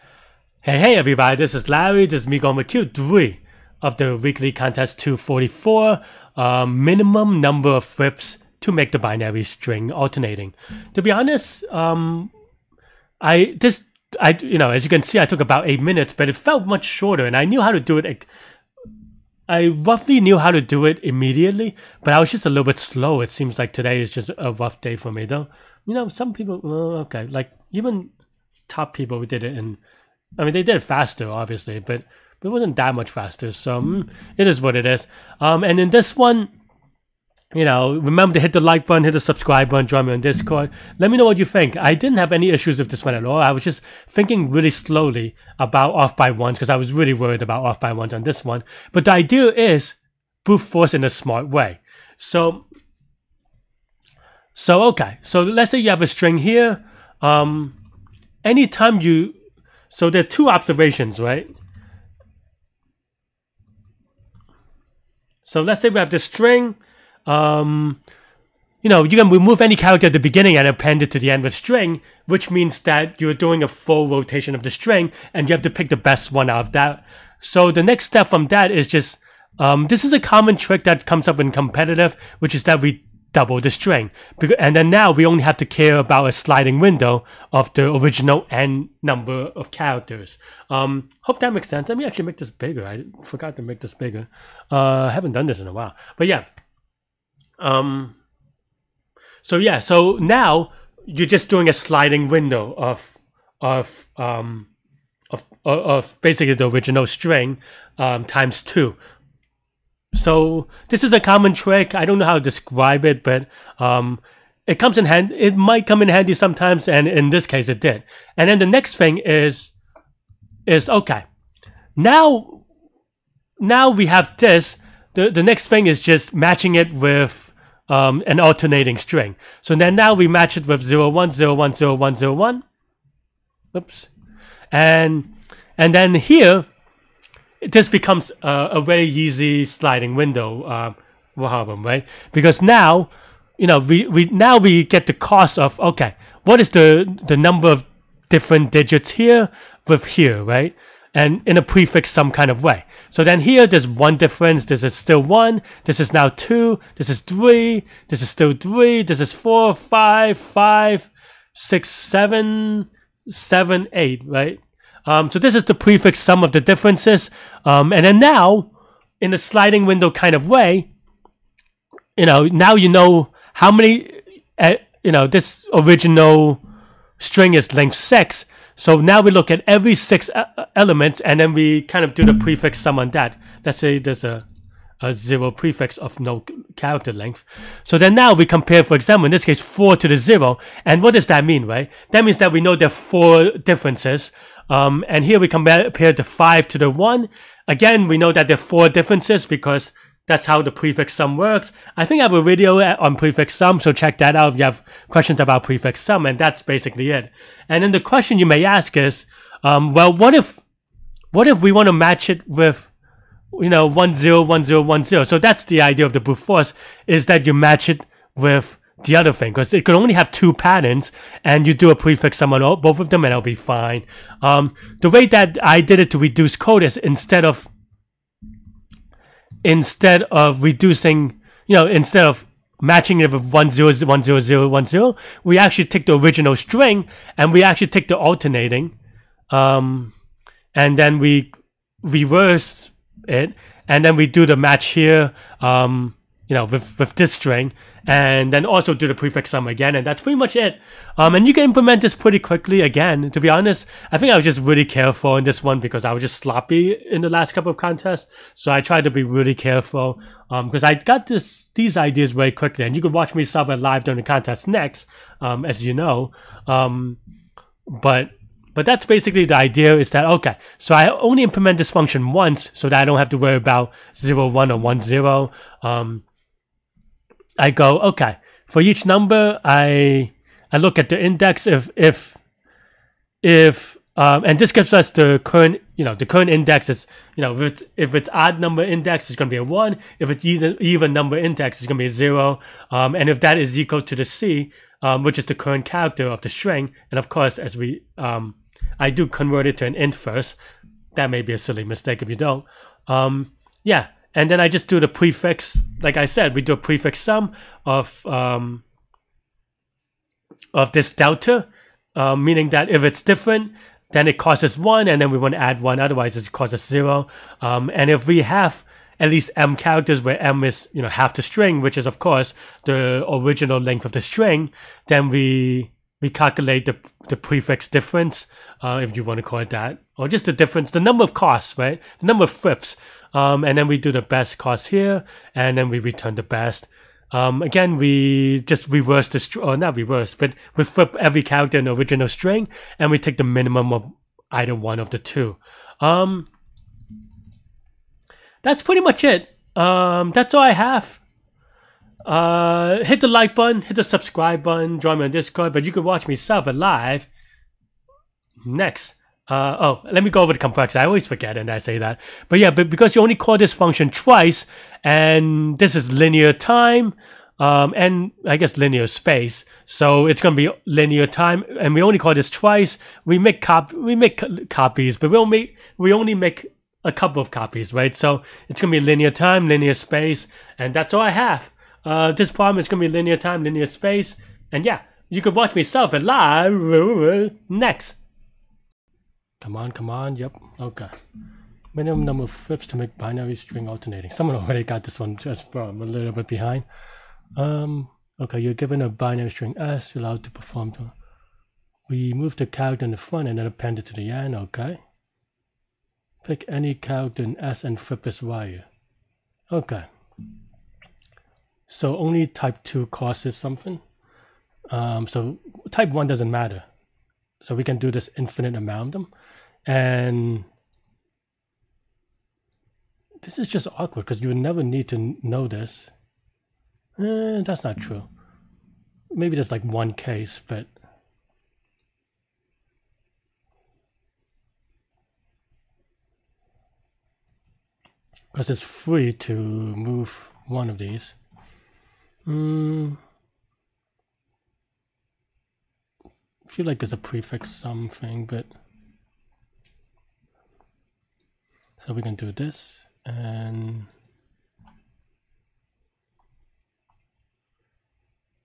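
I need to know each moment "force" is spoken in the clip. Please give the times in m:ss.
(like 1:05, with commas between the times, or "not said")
0:50, 3:36.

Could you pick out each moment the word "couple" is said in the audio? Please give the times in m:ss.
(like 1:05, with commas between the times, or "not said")
4:17, 6:17.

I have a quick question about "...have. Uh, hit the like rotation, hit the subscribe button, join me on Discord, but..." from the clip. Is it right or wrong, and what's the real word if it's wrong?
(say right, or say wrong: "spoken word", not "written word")
wrong: "button", not "rotation".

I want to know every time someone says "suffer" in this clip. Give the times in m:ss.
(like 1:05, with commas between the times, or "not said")
5:56.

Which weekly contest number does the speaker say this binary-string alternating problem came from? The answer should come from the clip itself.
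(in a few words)
244.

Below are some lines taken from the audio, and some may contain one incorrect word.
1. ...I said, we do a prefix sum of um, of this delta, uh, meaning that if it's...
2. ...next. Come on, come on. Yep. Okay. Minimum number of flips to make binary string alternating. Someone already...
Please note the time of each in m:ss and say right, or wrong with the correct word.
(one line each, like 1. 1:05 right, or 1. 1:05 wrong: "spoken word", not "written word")
1. 5:06 right
2. 6:27 right.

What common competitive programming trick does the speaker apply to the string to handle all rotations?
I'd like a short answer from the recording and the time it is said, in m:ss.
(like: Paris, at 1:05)
double the string, at 1:23.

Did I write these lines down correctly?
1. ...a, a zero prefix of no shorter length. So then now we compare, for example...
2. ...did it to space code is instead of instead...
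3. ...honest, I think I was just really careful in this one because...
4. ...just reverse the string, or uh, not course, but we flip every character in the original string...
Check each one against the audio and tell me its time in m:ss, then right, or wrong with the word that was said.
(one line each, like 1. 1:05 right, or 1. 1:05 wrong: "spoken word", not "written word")
1. 3:04 wrong: "character", not "shorter"
2. 3:45 wrong: "reduce", not "space"
3. 4:13 right
4. 5:38 wrong: "reverse", not "course".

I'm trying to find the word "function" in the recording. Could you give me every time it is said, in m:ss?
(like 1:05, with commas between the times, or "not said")
4:31, 6:03.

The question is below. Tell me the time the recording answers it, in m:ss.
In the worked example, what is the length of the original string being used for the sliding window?
2:57.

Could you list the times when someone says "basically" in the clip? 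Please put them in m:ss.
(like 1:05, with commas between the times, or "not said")
1:46, 3:26, 4:29.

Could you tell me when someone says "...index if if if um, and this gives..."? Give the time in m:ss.
4:41.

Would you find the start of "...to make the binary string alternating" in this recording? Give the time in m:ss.
0:08.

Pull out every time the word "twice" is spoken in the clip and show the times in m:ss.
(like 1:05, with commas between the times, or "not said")
6:04, 6:12.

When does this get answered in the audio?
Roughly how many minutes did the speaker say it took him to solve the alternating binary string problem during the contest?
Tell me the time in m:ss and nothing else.
0:15.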